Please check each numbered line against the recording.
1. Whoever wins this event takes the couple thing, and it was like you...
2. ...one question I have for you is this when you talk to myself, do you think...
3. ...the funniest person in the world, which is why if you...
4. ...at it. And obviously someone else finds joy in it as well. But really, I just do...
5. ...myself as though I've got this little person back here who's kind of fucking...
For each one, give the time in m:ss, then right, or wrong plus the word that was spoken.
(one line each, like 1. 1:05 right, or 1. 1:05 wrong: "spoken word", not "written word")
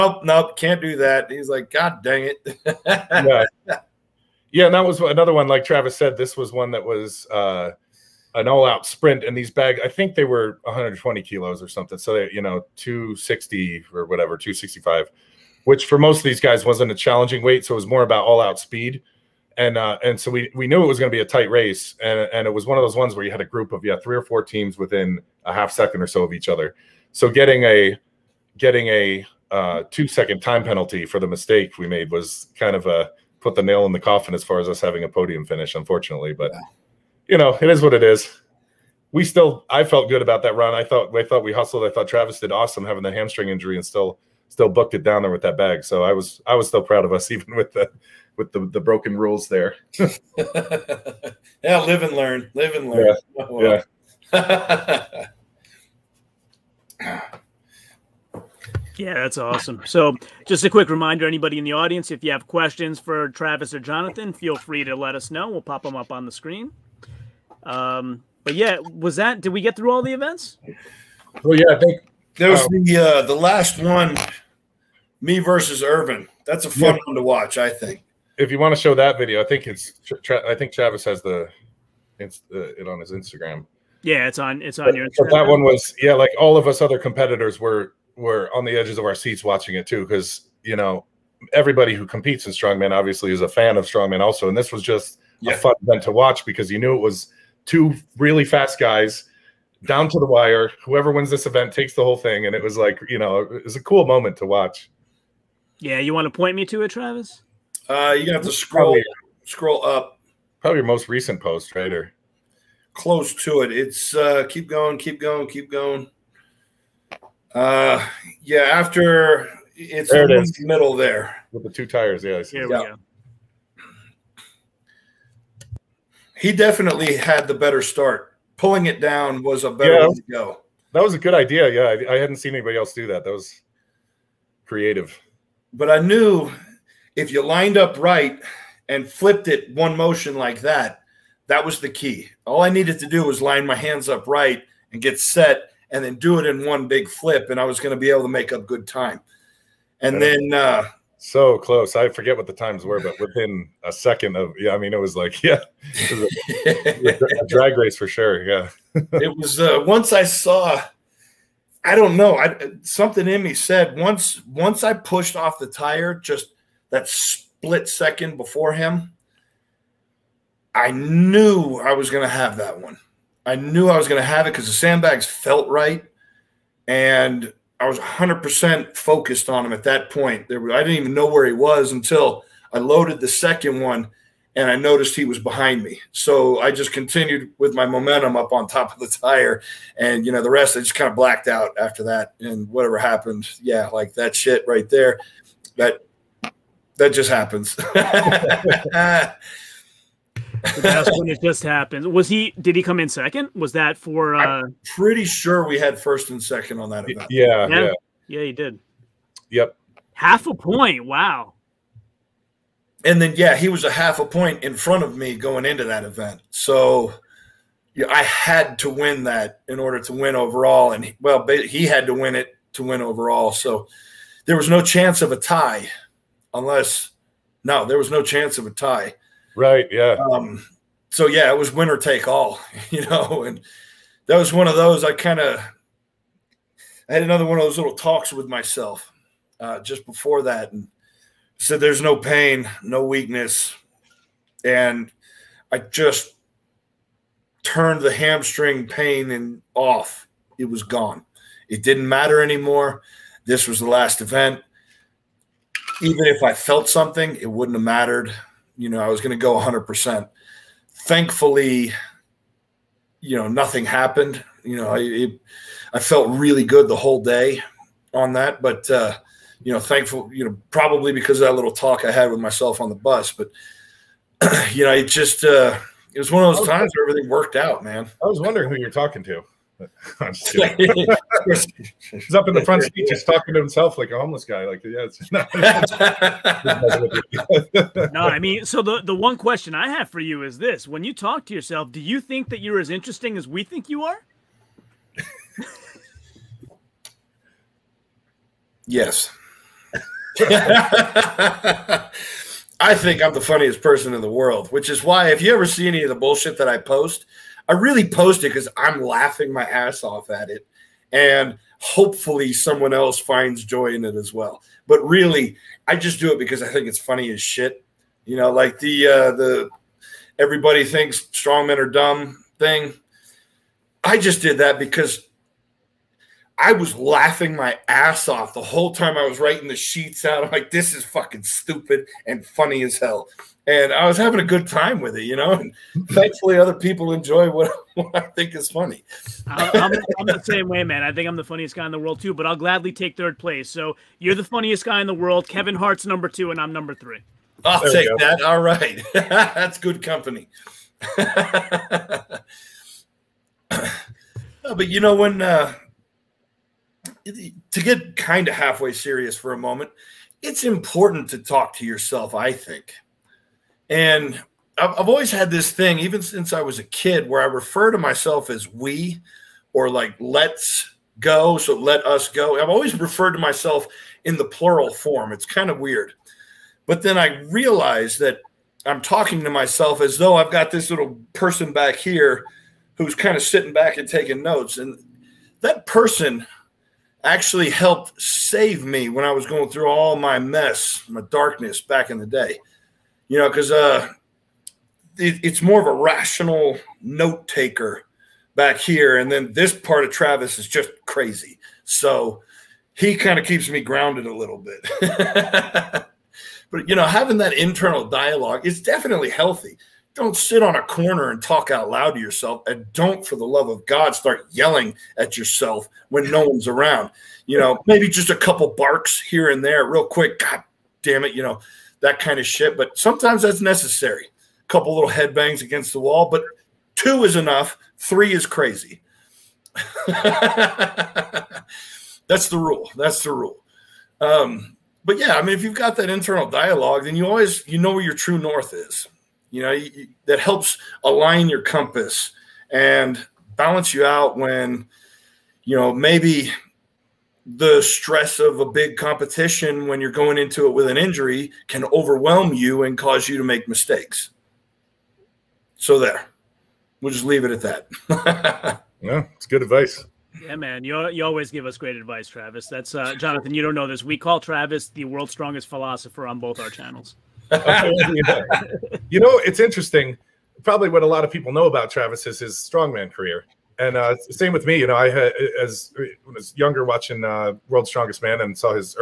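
1. 1:40 wrong: "whole", not "couple"
2. 4:49 wrong: "yourself", not "myself"
3. 5:03 right
4. 5:10 wrong: "hopefully", not "obviously"
5. 6:19 wrong: "sitting", not "fucking".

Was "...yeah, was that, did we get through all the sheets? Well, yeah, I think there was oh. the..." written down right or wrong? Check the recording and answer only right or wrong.
wrong.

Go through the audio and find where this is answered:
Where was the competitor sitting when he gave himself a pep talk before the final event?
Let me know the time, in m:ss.
4:32.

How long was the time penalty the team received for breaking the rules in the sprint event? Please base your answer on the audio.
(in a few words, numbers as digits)
2 seconds.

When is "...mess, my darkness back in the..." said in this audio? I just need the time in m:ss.
6:30.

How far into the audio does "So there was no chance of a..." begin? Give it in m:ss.
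3:43.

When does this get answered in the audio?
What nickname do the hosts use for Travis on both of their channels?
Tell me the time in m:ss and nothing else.
7:45.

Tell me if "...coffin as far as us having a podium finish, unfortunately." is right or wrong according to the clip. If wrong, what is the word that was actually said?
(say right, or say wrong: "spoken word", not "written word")
right.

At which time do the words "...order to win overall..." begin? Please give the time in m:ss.
3:39.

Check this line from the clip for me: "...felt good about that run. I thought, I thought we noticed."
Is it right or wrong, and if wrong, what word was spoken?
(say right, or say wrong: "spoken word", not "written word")
wrong: "hustled", not "noticed".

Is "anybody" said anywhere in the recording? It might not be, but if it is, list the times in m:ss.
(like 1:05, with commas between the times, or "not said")
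1:01, 2:12.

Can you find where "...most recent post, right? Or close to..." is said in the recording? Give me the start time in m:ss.
1:50.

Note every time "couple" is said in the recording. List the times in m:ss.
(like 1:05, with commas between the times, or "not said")
6:58, 7:04.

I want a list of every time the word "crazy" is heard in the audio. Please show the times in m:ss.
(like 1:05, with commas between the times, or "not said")
6:41, 7:08.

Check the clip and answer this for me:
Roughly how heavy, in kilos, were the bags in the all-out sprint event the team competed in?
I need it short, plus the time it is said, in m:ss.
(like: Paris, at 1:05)
120 kilos, at 0:10.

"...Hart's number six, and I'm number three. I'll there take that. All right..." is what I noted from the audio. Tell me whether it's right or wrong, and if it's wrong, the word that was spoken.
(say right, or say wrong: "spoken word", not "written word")
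wrong: "two", not "six".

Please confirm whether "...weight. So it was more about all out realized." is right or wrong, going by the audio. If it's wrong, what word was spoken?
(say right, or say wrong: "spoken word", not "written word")
wrong: "speed", not "realized".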